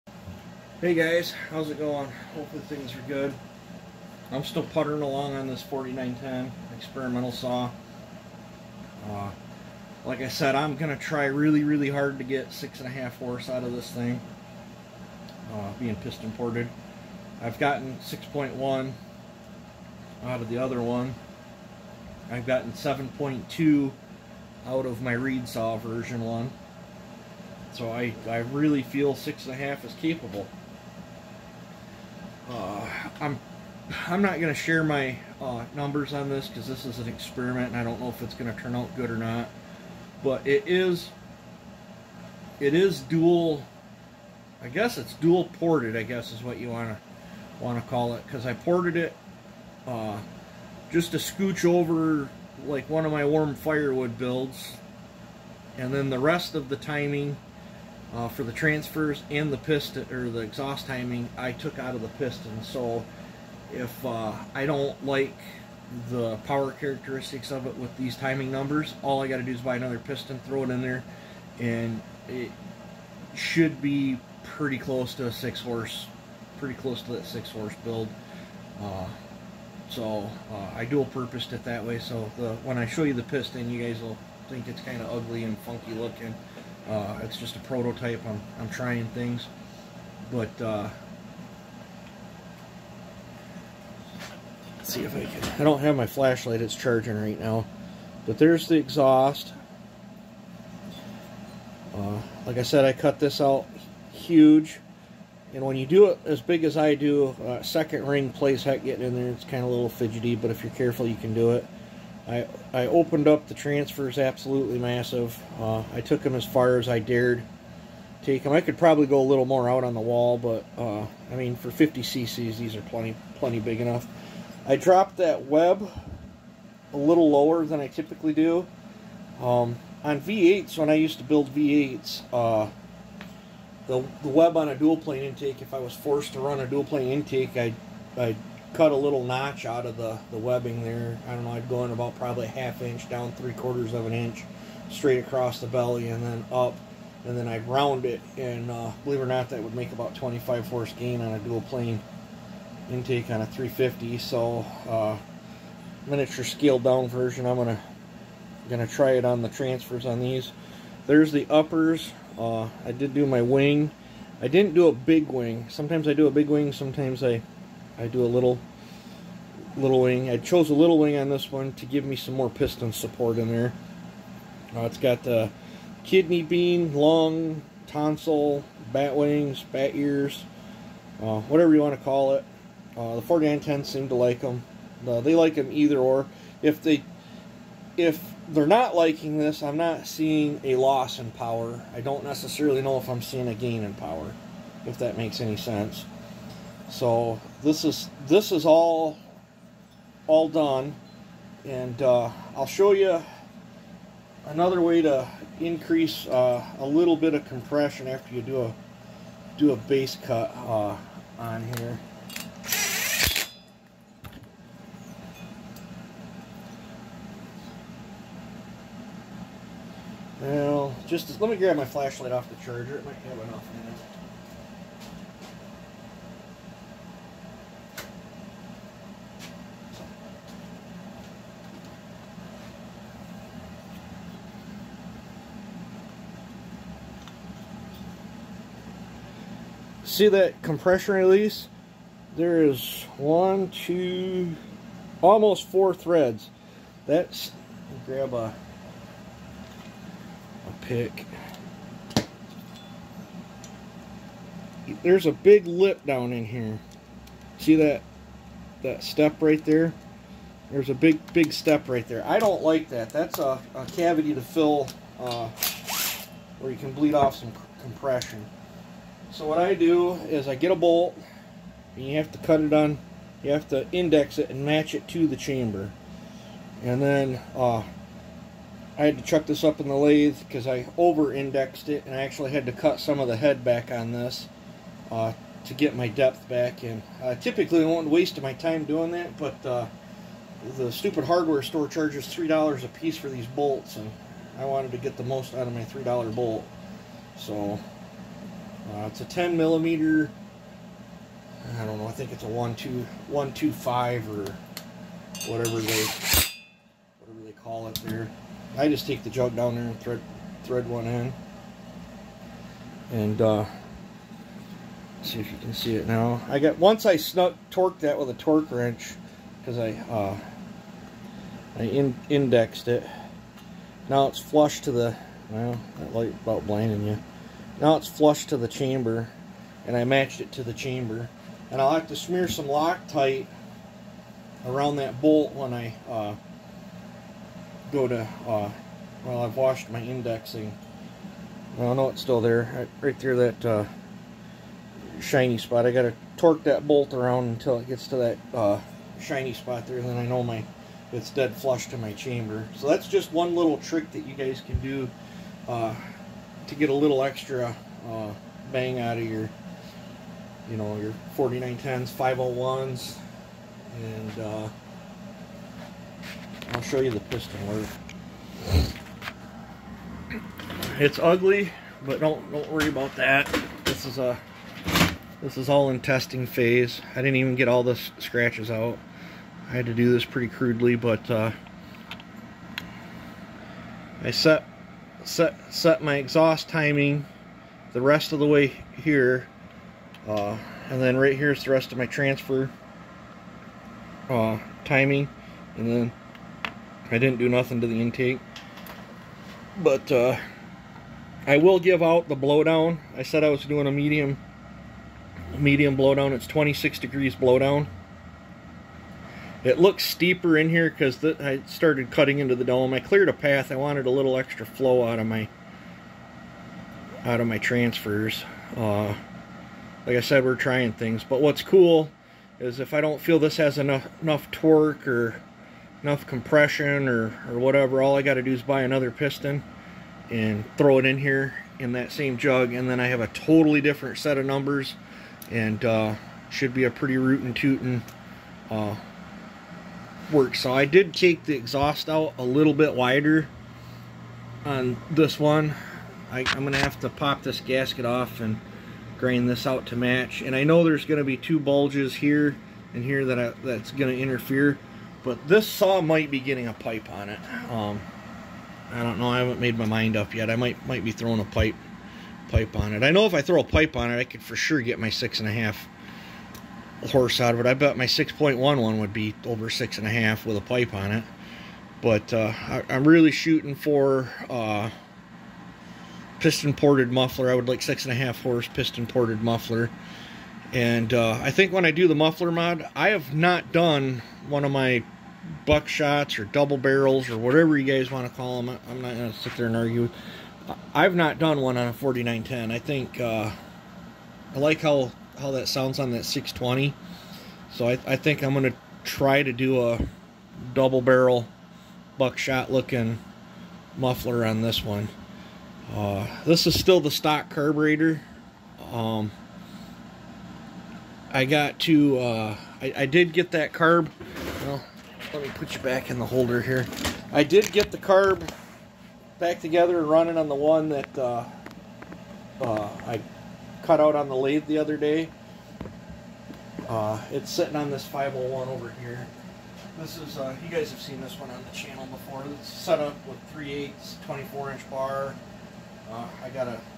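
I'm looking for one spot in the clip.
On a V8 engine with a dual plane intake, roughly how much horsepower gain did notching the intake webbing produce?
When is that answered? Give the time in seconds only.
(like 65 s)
150 s.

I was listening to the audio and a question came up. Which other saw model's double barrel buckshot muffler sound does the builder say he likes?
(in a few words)
620.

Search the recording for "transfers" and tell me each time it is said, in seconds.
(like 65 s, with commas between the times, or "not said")
58 s, 113 s, 159 s, 392 s, 417 s.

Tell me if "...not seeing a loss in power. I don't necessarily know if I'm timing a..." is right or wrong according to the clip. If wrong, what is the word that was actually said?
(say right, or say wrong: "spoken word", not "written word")
wrong: "seeing", not "timing".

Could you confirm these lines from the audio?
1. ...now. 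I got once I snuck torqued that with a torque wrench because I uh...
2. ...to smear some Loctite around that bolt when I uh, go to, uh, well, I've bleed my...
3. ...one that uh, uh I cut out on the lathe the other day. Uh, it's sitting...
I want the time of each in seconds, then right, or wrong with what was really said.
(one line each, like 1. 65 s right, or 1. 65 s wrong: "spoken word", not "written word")
1. 316 s right
2. 332 s wrong: "washed", not "bleed"
3. 520 s right.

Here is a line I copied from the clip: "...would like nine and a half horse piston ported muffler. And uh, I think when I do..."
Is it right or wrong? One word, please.
wrong.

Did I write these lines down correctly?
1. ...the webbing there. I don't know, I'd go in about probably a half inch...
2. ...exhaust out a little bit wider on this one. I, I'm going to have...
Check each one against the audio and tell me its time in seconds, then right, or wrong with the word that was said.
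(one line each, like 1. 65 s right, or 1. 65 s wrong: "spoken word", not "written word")
1. 140 s right
2. 441 s right.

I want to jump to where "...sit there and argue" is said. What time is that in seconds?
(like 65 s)
489 s.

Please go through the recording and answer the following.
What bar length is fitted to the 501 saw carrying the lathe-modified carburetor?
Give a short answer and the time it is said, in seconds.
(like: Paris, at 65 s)
24 inch, at 534 s.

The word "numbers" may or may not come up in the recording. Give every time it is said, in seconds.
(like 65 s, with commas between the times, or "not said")
35 s, 68 s, 434 s.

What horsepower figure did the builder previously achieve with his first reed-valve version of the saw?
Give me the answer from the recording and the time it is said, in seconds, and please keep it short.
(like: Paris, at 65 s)
7.2, at 22 s.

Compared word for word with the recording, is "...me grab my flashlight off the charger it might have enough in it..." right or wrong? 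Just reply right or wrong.
right.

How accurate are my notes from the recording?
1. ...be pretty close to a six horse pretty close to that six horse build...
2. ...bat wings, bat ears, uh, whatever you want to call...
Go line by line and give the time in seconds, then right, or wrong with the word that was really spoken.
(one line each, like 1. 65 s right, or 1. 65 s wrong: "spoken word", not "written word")
1. 73 s right
2. 178 s right.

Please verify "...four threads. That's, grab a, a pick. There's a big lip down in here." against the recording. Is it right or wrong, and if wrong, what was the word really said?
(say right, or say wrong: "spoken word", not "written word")
right.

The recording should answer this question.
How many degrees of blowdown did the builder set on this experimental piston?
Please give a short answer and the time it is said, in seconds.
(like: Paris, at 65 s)
26, at 406 s.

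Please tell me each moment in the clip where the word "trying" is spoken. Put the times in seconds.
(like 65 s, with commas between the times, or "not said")
88 s, 420 s.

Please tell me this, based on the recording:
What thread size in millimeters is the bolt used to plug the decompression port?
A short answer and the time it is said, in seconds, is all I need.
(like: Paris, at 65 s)
10 millimeter, at 299 s.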